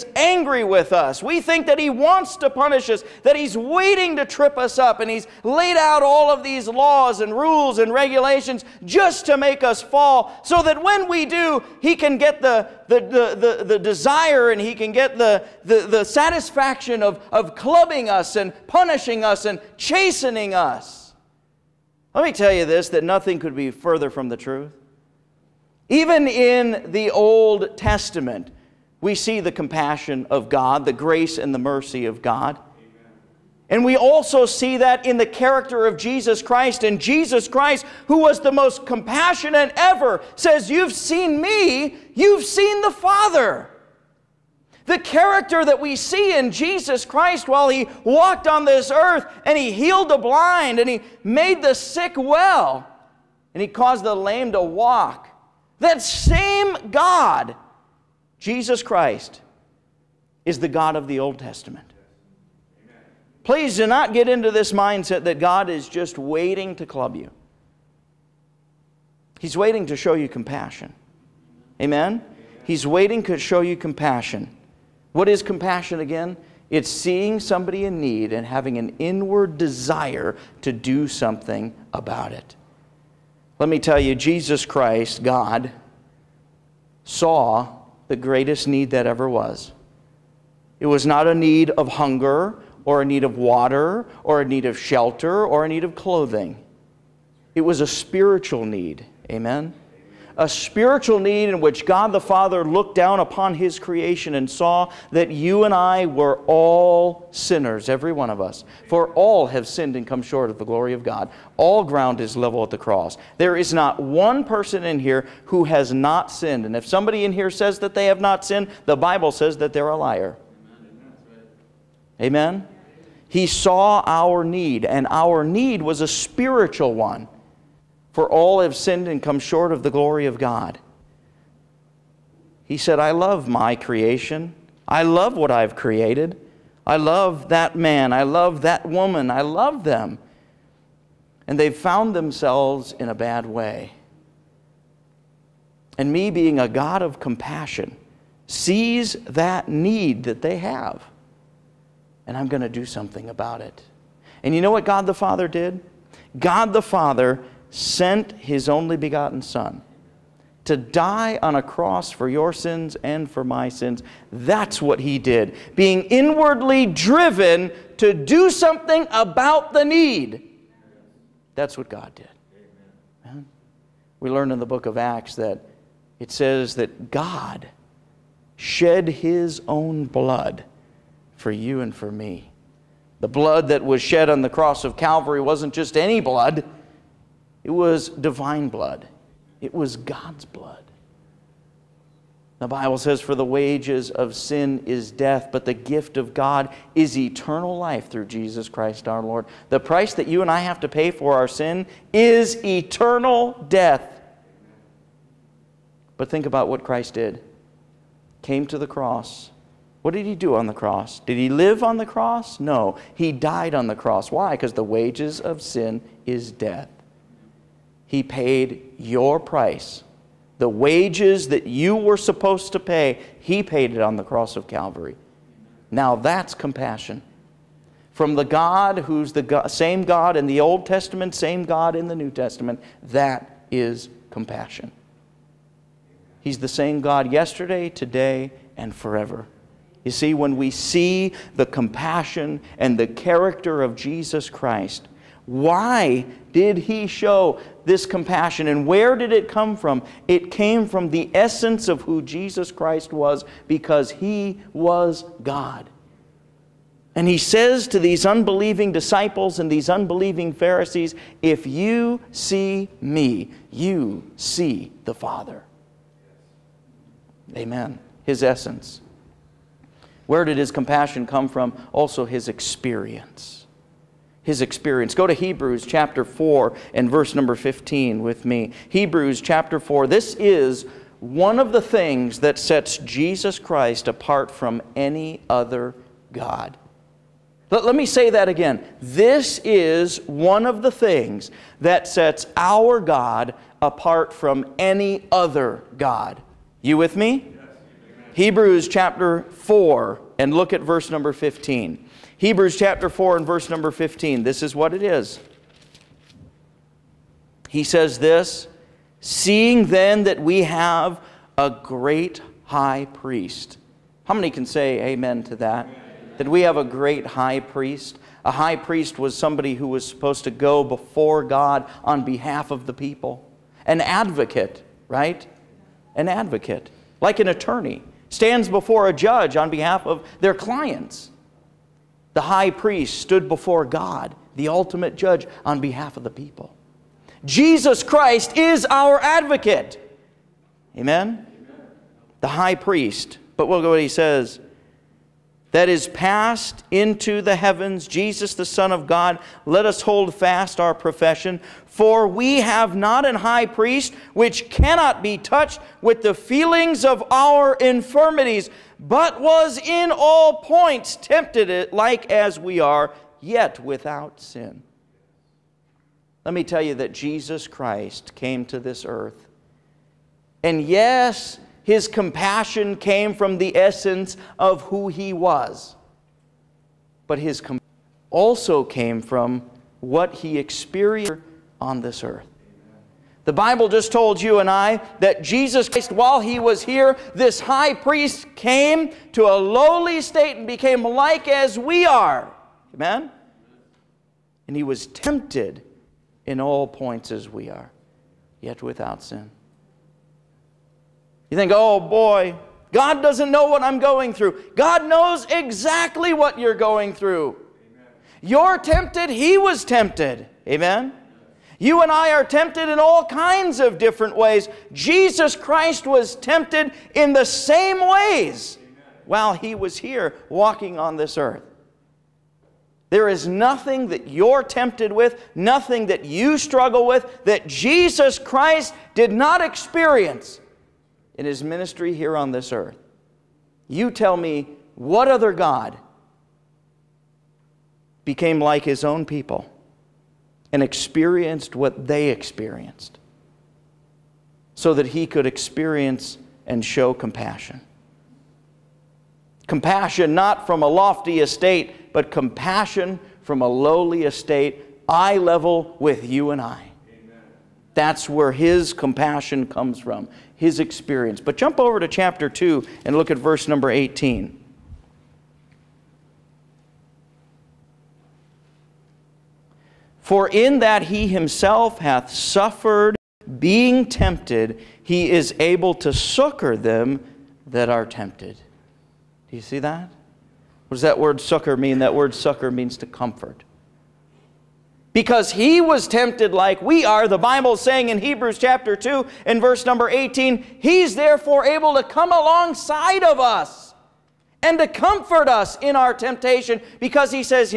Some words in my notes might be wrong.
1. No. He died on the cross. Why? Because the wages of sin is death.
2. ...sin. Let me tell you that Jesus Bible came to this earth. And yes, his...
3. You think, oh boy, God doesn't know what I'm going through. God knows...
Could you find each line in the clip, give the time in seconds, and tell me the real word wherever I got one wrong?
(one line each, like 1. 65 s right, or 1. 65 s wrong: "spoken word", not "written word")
1. 212 s right
2. 364 s wrong: "Christ", not "Bible"
3. 401 s right.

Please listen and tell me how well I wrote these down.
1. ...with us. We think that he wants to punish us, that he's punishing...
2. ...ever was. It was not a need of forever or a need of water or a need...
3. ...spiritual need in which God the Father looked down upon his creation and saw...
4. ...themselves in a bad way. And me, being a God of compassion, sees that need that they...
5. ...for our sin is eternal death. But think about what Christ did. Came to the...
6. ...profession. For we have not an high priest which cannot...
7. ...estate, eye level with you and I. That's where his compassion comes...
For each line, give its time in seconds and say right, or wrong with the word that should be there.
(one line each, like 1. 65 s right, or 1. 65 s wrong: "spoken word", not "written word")
1. 0 s wrong: "waiting", not "punishing"
2. 89 s wrong: "hunger", not "forever"
3. 100 s right
4. 142 s right
5. 201 s right
6. 350 s right
7. 454 s right.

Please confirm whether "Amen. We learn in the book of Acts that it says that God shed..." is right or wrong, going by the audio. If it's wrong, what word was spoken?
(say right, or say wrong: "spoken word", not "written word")
right.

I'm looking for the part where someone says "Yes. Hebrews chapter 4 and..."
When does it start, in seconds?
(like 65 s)
297 s.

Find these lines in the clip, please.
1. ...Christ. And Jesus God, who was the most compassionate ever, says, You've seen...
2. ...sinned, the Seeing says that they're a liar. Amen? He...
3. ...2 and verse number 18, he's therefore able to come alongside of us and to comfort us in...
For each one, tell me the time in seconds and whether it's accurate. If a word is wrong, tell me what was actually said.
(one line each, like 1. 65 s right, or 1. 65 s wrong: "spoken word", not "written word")
1. 36 s wrong: "Christ", not "God"
2. 118 s wrong: "Bible", not "Seeing"
3. 488 s right.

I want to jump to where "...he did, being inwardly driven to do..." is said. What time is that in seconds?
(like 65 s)
164 s.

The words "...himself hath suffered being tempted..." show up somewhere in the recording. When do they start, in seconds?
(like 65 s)
471 s.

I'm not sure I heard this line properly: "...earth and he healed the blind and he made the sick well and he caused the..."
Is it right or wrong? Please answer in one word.
right.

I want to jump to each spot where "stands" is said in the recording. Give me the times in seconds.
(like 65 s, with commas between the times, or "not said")
328 s.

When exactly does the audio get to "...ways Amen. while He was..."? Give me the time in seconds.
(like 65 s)
418 s.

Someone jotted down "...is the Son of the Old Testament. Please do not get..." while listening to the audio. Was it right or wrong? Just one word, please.
wrong.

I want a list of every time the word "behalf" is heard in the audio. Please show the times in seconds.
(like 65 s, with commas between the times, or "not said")
322 s, 329 s, 335 s.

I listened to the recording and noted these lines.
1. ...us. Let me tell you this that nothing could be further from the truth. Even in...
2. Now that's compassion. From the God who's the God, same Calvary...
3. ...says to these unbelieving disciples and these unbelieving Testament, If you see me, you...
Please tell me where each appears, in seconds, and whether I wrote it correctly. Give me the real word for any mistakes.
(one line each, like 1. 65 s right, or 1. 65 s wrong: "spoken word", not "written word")
1. 20 s right
2. 225 s wrong: "God", not "Calvary"
3. 257 s wrong: "Pharisees", not "Testament".